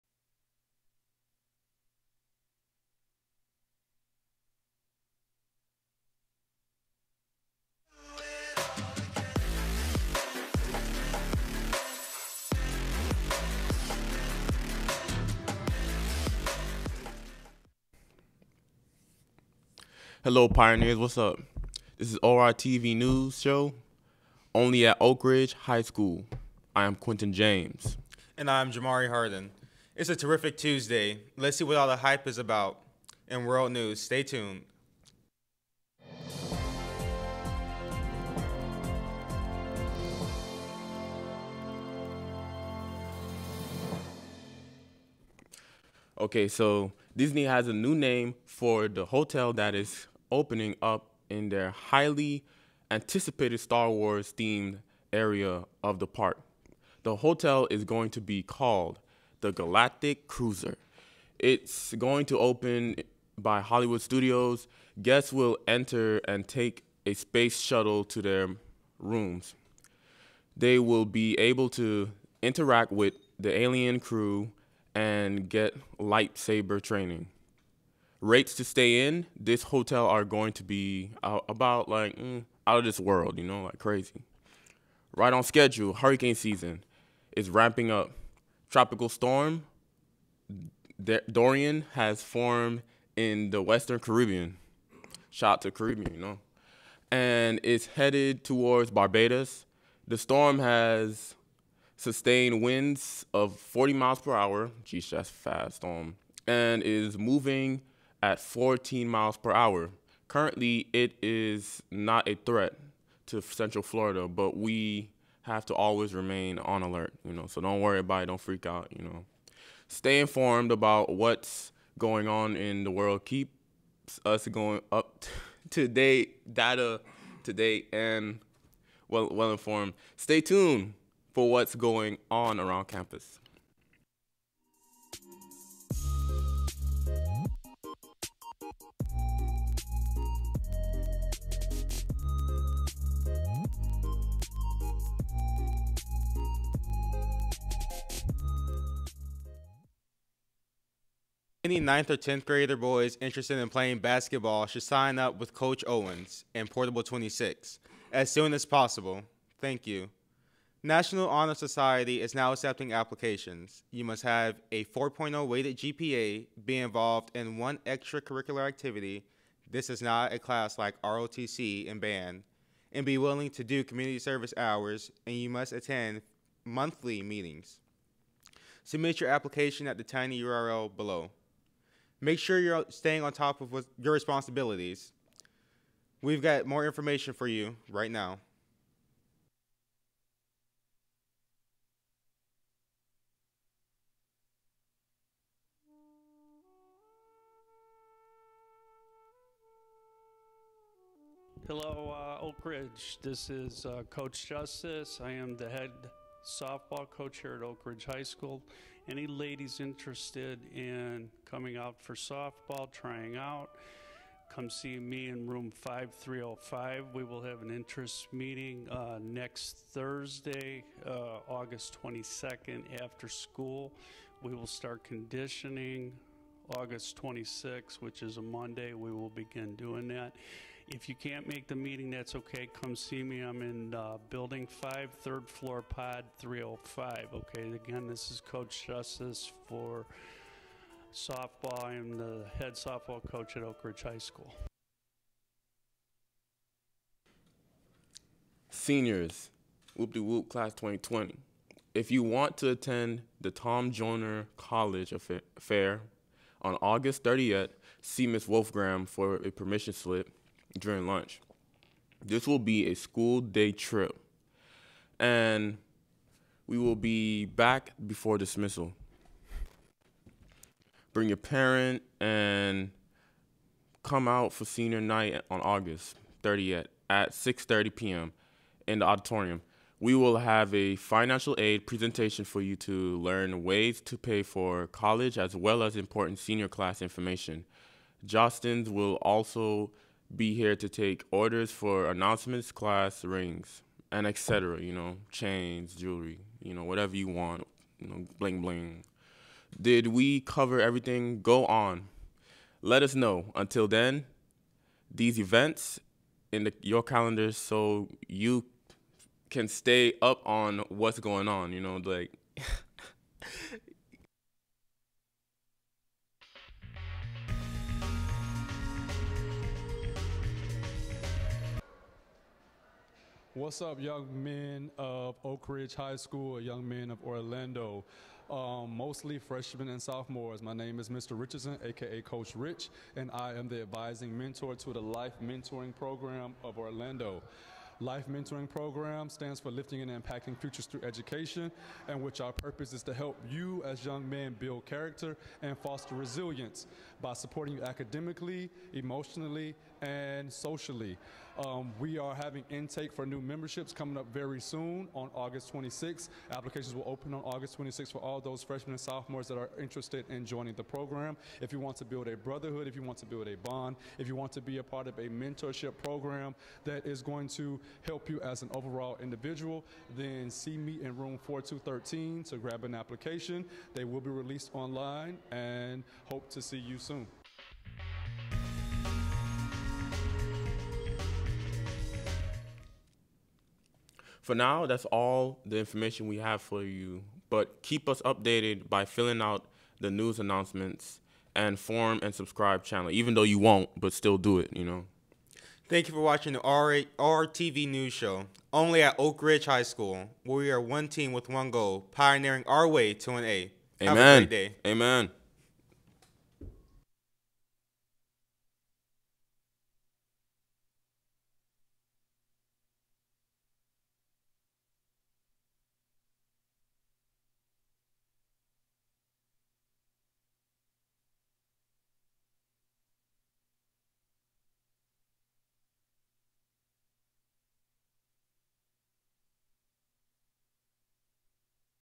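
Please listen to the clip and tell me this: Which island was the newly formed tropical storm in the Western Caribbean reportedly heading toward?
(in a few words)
Barbados.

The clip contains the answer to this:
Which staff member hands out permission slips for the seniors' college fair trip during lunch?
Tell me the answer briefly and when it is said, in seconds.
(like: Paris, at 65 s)
Ms. Wolfgram, at 258 s.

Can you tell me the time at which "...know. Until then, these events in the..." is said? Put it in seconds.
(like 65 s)
303 s.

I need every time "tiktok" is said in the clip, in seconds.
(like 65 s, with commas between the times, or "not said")
not said.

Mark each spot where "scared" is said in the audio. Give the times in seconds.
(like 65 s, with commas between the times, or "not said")
not said.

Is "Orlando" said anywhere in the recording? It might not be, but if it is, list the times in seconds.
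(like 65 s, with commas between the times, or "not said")
327 s, 336 s.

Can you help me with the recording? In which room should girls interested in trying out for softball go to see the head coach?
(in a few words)
5305.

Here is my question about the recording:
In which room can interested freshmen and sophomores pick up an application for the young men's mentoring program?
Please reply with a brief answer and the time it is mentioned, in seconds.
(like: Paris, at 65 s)
4213, at 371 s.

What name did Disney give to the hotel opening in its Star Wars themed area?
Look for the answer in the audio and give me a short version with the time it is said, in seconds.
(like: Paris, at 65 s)
Galactic Cruiser, at 59 s.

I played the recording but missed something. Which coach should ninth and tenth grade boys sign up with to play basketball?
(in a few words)
Coach Owens.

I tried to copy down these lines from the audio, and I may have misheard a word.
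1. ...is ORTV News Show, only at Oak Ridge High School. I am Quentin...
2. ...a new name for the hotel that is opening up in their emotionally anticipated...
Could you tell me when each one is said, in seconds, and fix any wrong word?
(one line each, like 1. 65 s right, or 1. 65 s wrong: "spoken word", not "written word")
1. 22 s right
2. 47 s wrong: "highly", not "emotionally".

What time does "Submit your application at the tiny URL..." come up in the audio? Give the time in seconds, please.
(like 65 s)
178 s.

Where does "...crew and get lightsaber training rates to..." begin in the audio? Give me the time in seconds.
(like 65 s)
73 s.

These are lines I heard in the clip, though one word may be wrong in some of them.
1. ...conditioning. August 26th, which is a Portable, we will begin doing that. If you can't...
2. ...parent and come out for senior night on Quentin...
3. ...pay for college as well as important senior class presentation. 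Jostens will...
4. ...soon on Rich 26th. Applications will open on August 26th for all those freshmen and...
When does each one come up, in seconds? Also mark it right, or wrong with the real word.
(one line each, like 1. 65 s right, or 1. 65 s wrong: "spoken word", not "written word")
1. 225 s wrong: "Monday", not "Portable"
2. 271 s wrong: "August", not "Quentin"
3. 284 s wrong: "information", not "presentation"
4. 354 s wrong: "August", not "Rich".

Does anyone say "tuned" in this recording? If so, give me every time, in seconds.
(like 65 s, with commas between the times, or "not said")
34 s, 130 s.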